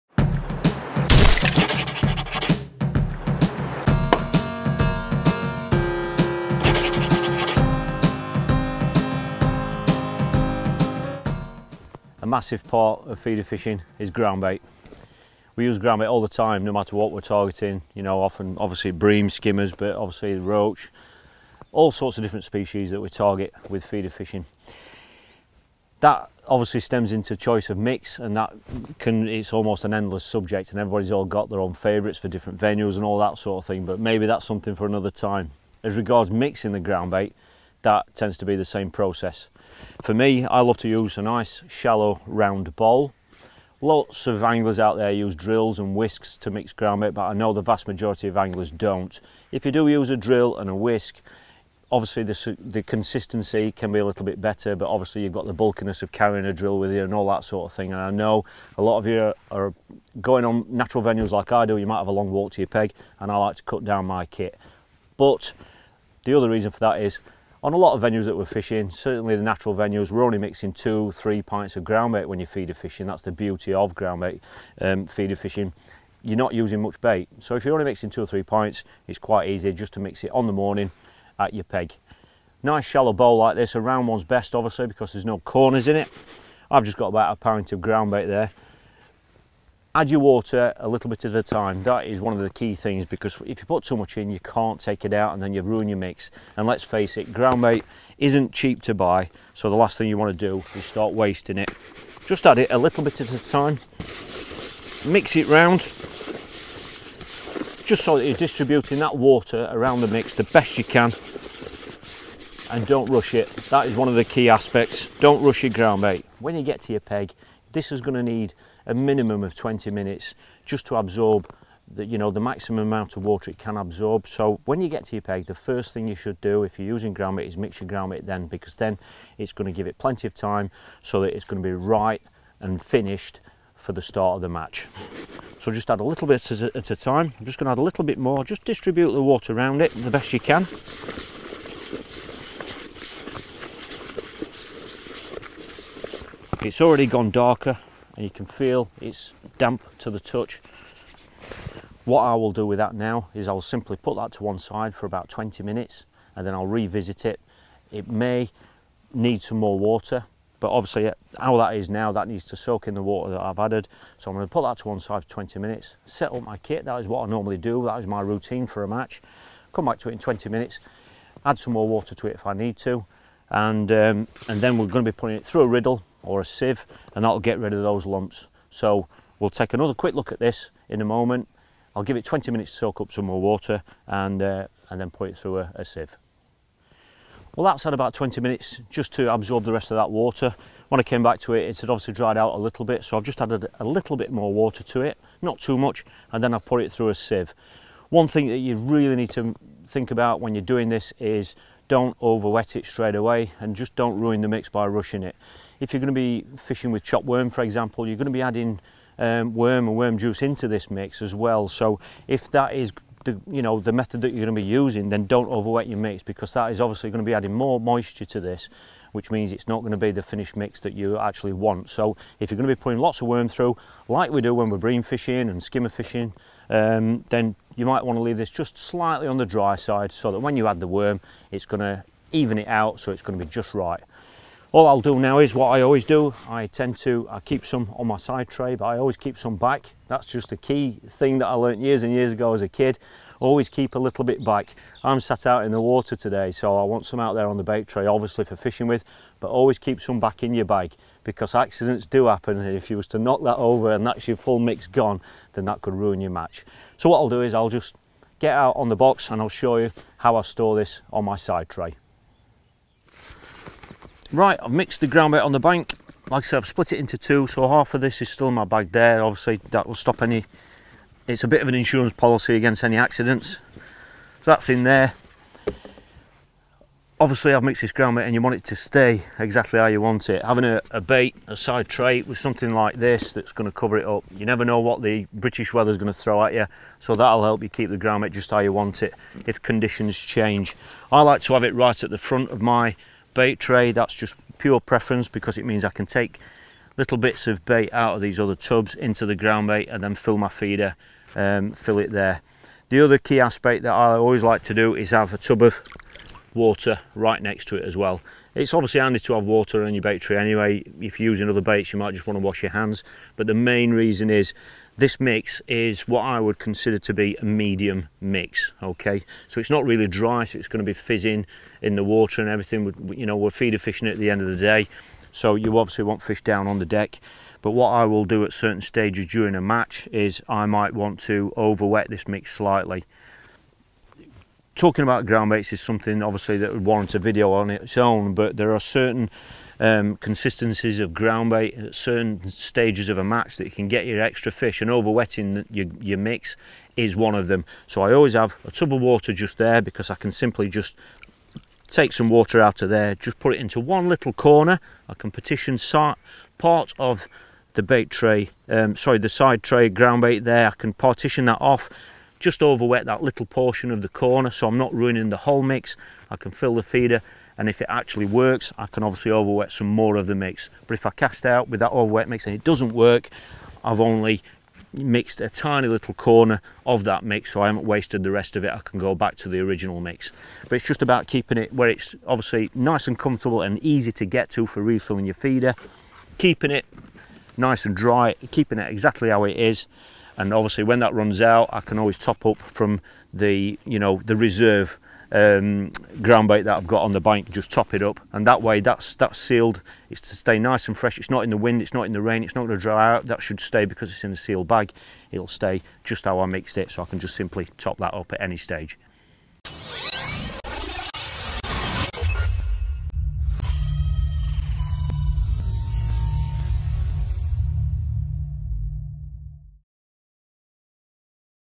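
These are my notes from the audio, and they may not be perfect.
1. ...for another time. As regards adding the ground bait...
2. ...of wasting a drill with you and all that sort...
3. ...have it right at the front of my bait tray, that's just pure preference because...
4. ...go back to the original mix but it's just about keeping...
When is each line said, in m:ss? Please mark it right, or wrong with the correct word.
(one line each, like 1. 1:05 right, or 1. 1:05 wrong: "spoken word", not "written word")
1. 0:34 wrong: "mixing", not "adding"
2. 0:56 wrong: "carrying", not "wasting"
3. 4:51 right
4. 6:18 right.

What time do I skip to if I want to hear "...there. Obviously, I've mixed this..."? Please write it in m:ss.
4:34.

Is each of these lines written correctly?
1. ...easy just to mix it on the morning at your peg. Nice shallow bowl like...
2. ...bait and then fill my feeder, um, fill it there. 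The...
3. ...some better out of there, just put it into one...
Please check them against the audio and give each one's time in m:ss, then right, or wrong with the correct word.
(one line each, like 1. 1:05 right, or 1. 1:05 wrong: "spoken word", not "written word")
1. 1:19 right
2. 4:59 right
3. 5:52 wrong: "water", not "better".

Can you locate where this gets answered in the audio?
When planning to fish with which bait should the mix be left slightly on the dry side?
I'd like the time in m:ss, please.
3:27.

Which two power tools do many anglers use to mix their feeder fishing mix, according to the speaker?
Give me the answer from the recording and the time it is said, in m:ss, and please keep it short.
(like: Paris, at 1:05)
Drills and whisks, at 0:45.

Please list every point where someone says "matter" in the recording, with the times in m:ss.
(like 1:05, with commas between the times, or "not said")
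0:16.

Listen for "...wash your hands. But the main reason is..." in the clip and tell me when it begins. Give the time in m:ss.
5:12.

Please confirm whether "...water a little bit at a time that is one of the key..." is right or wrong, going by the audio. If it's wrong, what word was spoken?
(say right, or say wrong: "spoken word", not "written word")
right.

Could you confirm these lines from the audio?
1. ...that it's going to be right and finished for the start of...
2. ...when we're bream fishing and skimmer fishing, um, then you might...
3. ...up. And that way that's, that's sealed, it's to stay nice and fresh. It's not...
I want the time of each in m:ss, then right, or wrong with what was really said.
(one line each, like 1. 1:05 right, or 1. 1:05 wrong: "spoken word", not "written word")
1. 2:11 right
2. 3:44 right
3. 6:38 right.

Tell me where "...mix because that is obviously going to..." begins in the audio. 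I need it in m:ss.
3:35.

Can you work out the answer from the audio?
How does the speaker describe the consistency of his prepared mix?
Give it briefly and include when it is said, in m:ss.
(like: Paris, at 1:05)
Medium mix, at 5:17.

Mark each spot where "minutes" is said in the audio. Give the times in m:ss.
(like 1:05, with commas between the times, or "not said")
1:59, 2:35, 2:45, 2:50, 3:02, 3:08.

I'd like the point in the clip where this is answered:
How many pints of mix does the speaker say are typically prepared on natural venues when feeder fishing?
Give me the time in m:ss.
1:10.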